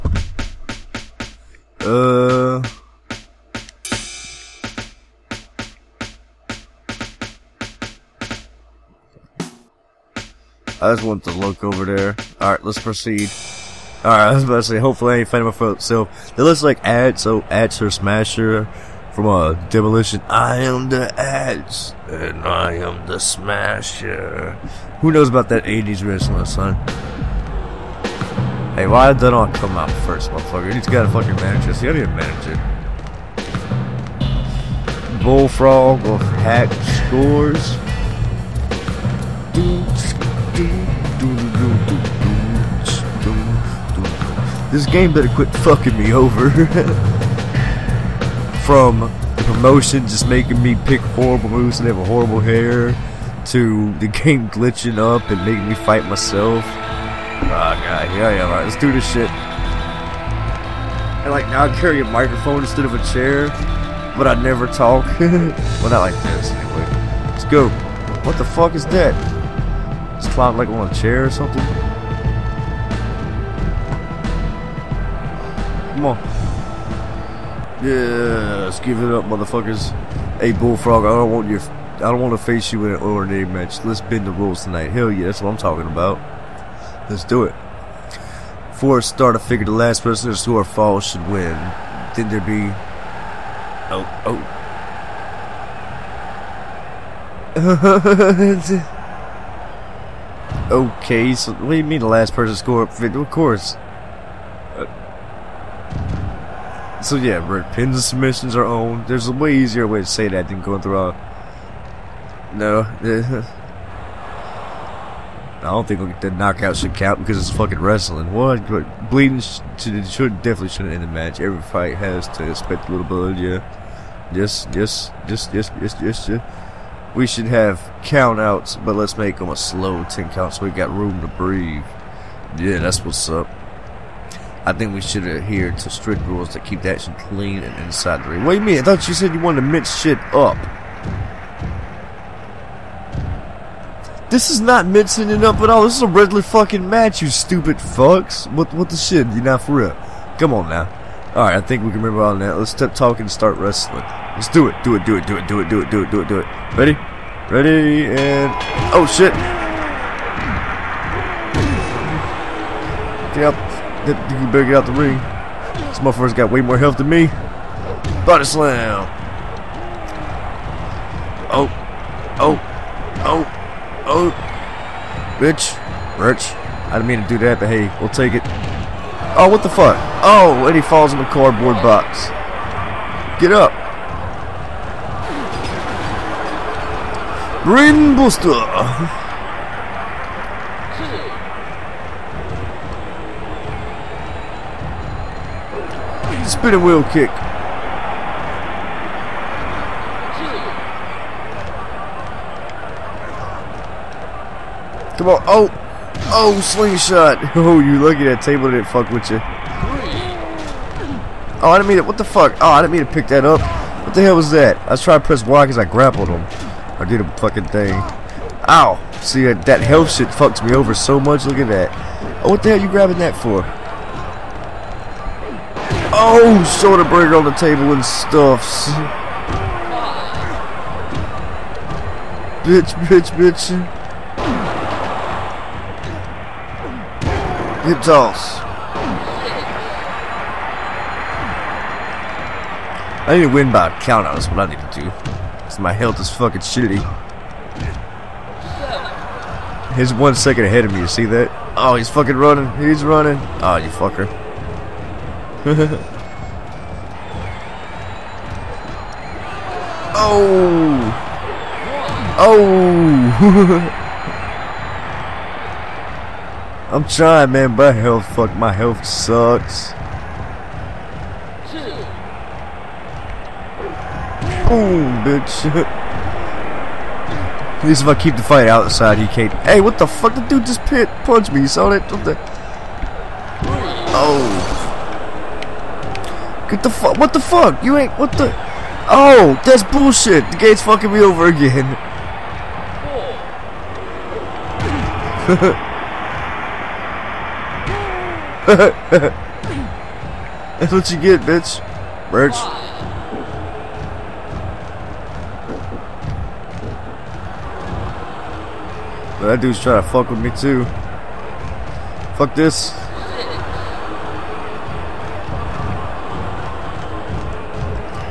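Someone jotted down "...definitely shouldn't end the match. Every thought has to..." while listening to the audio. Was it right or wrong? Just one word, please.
wrong.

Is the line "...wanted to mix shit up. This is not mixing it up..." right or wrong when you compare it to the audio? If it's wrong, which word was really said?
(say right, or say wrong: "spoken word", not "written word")
right.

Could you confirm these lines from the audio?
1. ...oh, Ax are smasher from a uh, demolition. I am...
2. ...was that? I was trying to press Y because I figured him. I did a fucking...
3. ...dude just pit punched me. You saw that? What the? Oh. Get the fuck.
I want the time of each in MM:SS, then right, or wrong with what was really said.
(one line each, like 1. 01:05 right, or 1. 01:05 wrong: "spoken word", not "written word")
1. 00:17 right
2. 03:34 wrong: "grappled", not "figured"
3. 04:40 right.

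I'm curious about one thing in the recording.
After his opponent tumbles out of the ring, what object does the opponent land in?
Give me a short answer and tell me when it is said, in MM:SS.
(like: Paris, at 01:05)
cardboard box, at 03:01.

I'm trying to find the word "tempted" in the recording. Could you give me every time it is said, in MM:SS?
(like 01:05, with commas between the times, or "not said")
not said.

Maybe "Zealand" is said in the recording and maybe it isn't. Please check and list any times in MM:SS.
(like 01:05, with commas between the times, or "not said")
not said.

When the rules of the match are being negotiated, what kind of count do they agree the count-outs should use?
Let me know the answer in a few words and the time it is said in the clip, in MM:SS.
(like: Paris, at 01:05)
slow ten count, at 02:09.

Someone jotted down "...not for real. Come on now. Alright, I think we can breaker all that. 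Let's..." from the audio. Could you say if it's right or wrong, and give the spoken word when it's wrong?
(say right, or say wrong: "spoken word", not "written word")
wrong: "remember", not "breaker".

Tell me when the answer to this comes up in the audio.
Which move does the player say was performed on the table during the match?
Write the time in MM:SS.
03:46.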